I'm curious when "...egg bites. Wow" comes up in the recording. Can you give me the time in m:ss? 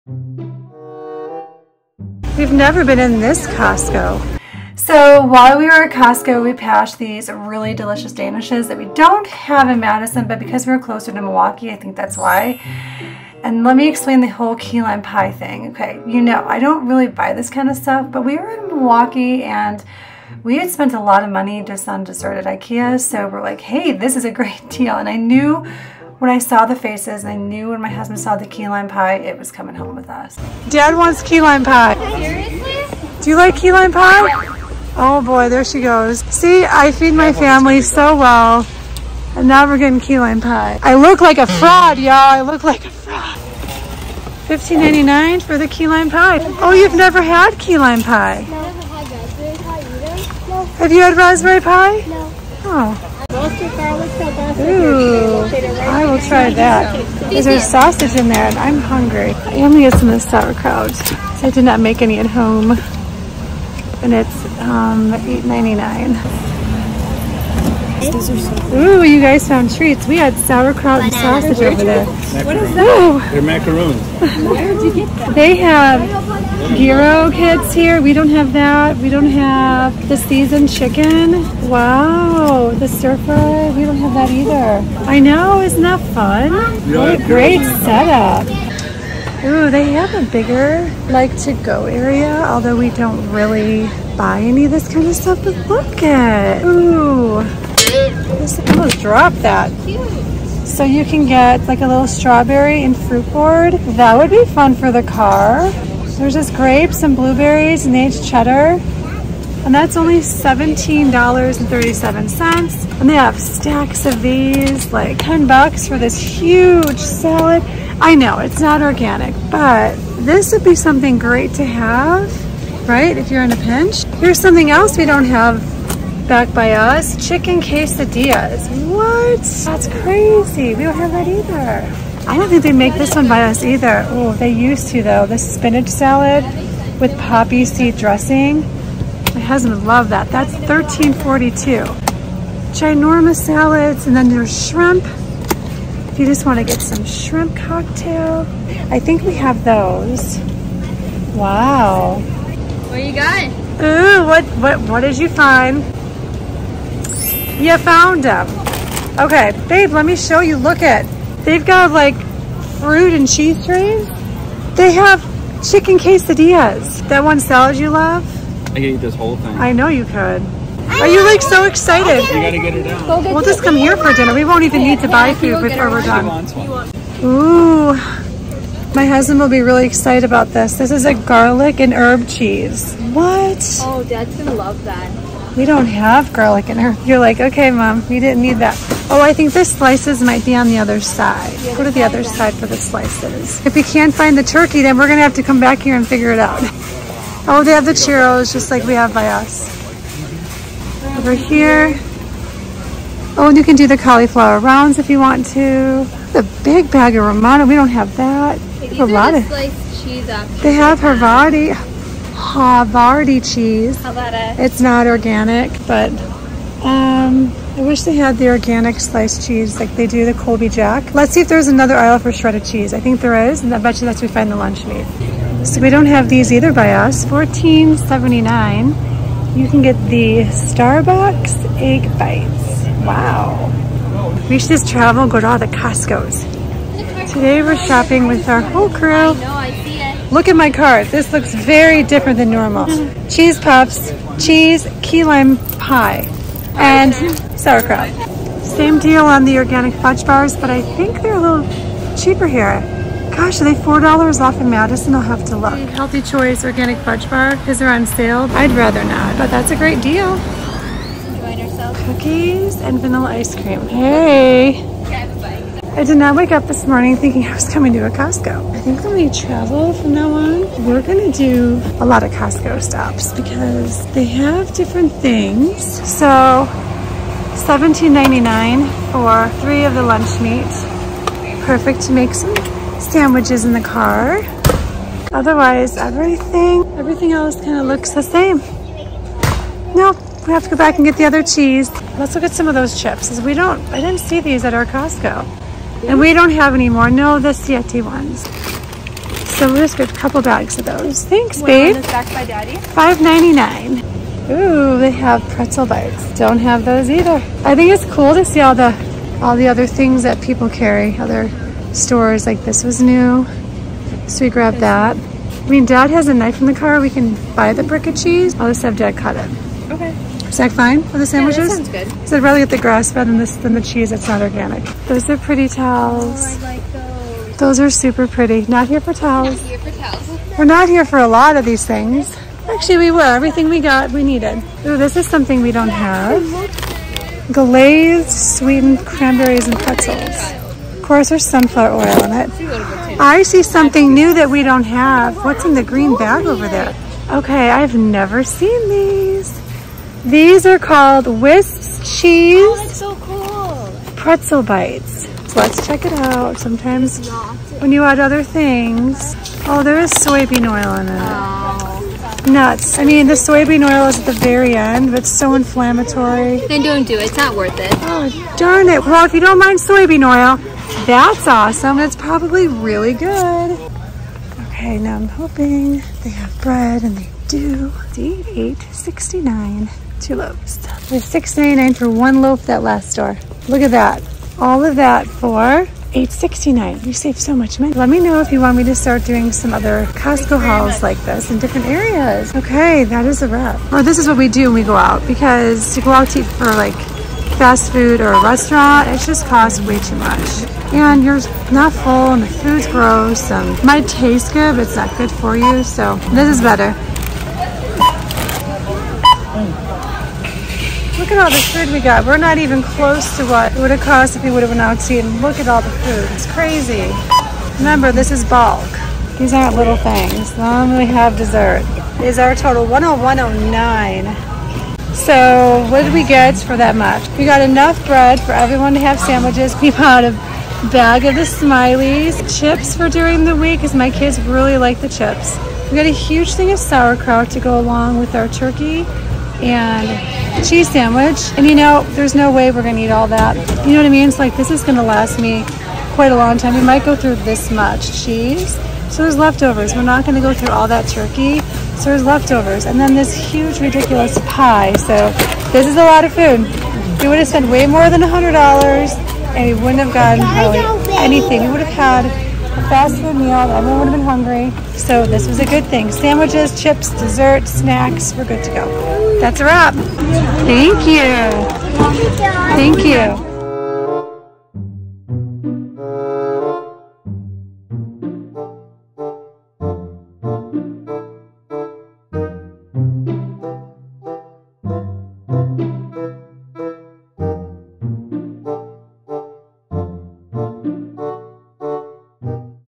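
3:51.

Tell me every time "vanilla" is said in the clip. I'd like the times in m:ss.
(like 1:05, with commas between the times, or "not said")
4:22.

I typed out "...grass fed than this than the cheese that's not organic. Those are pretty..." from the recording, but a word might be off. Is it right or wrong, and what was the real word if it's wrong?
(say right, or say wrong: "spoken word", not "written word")
right.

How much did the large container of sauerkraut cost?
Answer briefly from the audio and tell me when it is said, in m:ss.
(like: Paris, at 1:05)
$8.99, at 1:05.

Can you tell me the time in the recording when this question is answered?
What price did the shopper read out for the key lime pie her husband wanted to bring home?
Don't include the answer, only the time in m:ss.
0:44.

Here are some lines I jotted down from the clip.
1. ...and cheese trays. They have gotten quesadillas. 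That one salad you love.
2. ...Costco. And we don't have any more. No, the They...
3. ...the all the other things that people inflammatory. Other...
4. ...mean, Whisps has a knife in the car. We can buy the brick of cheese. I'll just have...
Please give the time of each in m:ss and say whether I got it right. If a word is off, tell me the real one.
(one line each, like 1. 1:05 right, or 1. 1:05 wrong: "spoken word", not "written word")
1. 2:43 wrong: "chicken", not "gotten"
2. 4:54 wrong: "Siete", not "They"
3. 5:08 wrong: "carry", not "inflammatory"
4. 5:15 wrong: "Dad", not "Whisps".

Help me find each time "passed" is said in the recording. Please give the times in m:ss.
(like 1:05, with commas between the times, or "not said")
0:06.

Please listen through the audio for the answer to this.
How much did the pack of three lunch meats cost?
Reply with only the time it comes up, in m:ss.
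4:37.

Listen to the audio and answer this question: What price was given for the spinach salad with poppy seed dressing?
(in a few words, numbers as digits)
$13.42.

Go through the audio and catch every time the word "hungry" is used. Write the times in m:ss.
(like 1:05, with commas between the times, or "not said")
0:58, 7:44.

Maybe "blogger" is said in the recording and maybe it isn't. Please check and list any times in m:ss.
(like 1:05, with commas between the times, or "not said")
not said.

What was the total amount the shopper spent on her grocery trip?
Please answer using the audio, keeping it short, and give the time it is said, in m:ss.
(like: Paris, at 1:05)
$101.09, at 7:02.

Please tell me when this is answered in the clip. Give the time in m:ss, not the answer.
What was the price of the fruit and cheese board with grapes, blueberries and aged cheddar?
1:50.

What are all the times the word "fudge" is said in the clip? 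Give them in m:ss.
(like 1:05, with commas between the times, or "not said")
4:09, 4:16.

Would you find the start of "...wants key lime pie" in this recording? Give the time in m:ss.
0:30.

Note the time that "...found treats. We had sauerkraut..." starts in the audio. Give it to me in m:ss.
1:09.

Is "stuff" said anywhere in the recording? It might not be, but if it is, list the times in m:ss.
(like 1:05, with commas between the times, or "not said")
0:17, 1:35.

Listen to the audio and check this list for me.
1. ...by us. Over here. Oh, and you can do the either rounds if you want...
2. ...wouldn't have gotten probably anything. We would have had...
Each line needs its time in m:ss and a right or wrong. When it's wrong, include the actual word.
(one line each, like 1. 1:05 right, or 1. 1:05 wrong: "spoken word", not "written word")
1. 3:19 wrong: "cauliflower", not "either"
2. 7:39 right.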